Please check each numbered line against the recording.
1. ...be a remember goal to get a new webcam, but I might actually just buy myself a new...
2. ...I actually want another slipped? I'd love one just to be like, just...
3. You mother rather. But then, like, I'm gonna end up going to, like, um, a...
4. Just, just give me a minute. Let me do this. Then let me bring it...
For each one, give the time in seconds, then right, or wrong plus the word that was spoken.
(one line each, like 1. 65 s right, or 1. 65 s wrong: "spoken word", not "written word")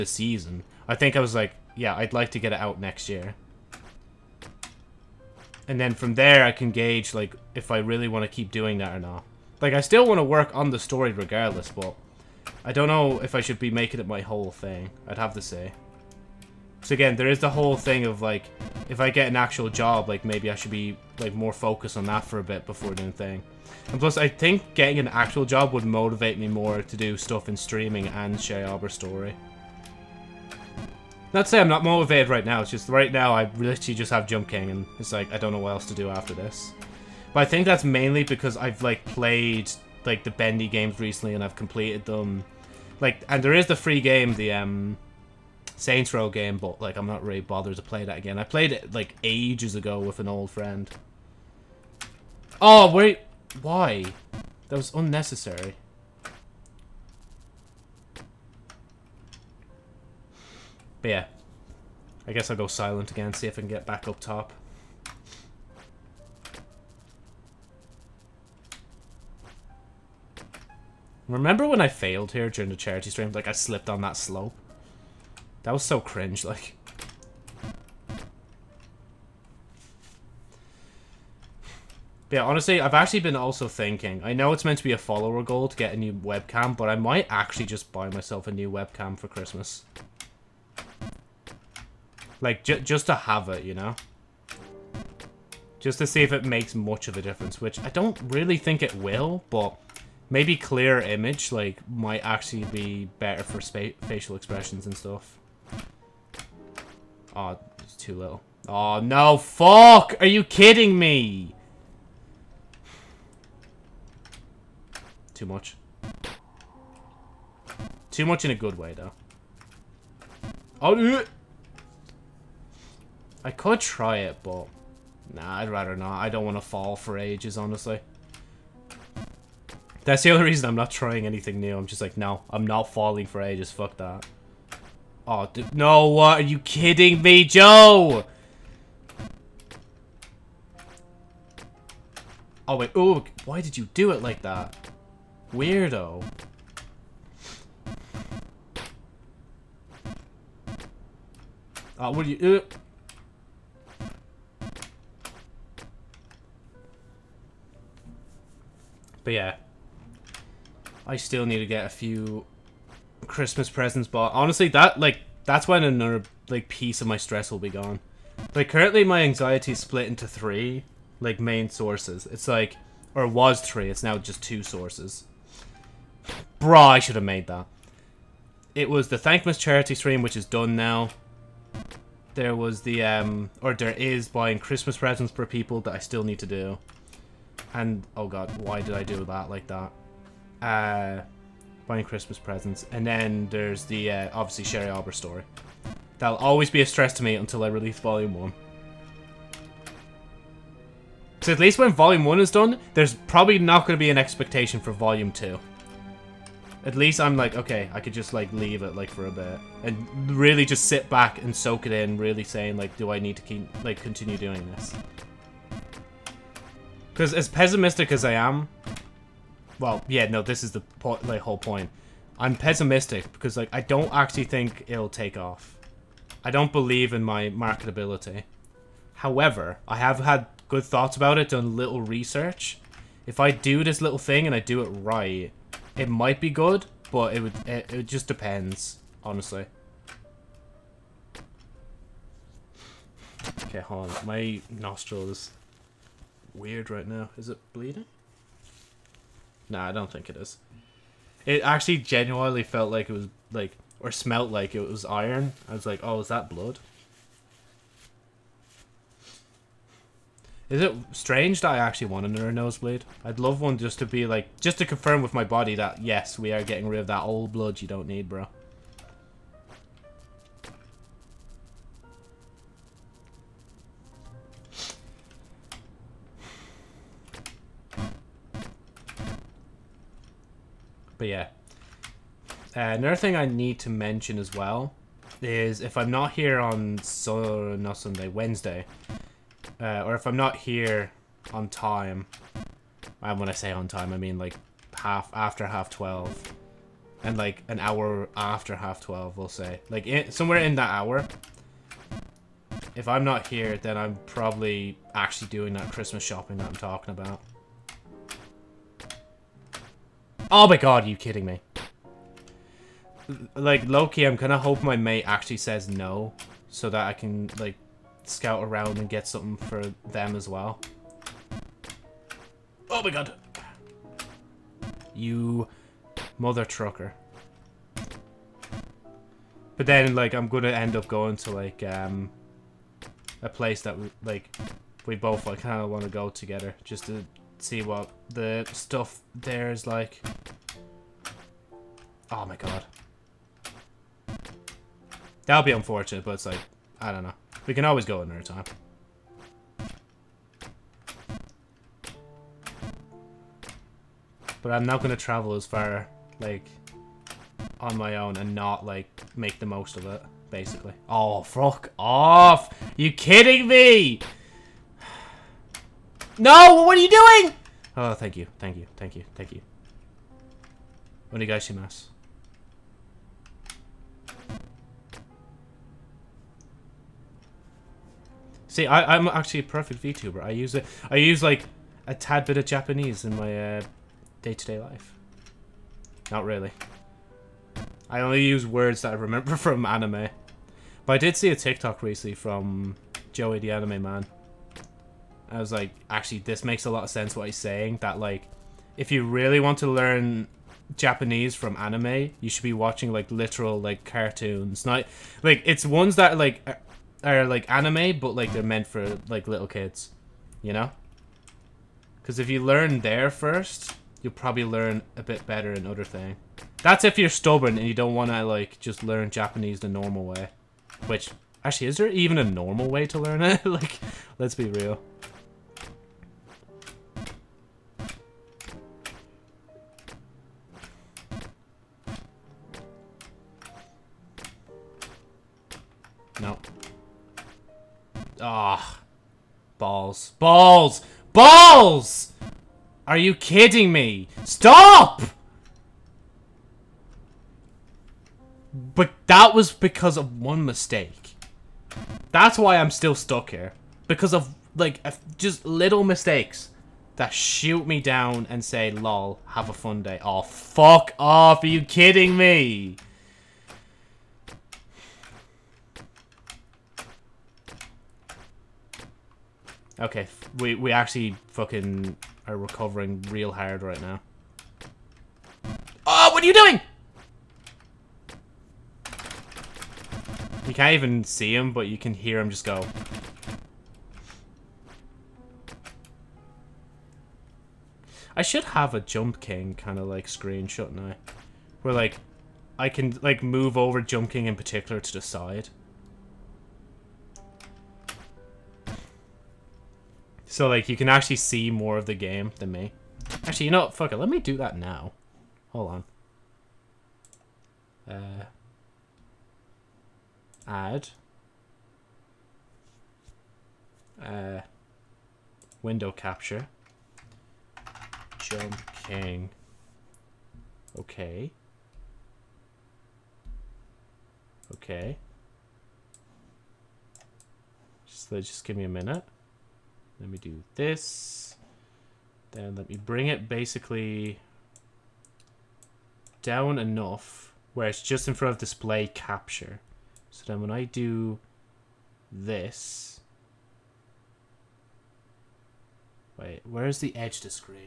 1. 84 s wrong: "follower", not "remember"
2. 261 s wrong: "nosebleed", not "slipped"
3. 325 s wrong: "trucker", not "rather"
4. 528 s right.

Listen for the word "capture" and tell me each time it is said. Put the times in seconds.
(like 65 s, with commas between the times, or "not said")
516 s, 539 s.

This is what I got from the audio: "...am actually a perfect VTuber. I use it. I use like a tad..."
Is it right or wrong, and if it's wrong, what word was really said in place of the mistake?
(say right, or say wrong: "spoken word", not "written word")
right.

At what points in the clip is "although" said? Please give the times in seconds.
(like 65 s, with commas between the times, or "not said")
not said.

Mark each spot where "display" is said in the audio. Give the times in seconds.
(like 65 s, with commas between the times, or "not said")
538 s.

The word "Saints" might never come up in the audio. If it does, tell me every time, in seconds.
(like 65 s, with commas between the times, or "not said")
45 s.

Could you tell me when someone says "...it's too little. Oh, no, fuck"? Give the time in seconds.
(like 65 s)
107 s.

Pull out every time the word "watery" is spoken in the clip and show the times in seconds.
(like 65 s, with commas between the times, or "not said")
not said.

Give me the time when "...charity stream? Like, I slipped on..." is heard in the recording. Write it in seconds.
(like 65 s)
72 s.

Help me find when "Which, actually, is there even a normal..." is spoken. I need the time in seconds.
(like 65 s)
421 s.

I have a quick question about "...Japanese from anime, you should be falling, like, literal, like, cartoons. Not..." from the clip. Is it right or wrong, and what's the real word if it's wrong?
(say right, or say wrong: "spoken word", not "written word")
wrong: "watching", not "falling".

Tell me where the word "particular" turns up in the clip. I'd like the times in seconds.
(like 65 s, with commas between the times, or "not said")
494 s.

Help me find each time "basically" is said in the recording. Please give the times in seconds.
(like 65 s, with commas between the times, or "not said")
360 s, 533 s.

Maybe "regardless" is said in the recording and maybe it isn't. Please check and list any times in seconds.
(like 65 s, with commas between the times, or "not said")
11 s.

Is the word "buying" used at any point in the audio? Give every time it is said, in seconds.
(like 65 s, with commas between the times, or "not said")
184 s, 191 s.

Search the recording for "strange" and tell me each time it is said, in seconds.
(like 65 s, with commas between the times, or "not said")
261 s.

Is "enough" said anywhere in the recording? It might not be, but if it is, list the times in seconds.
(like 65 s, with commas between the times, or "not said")
536 s.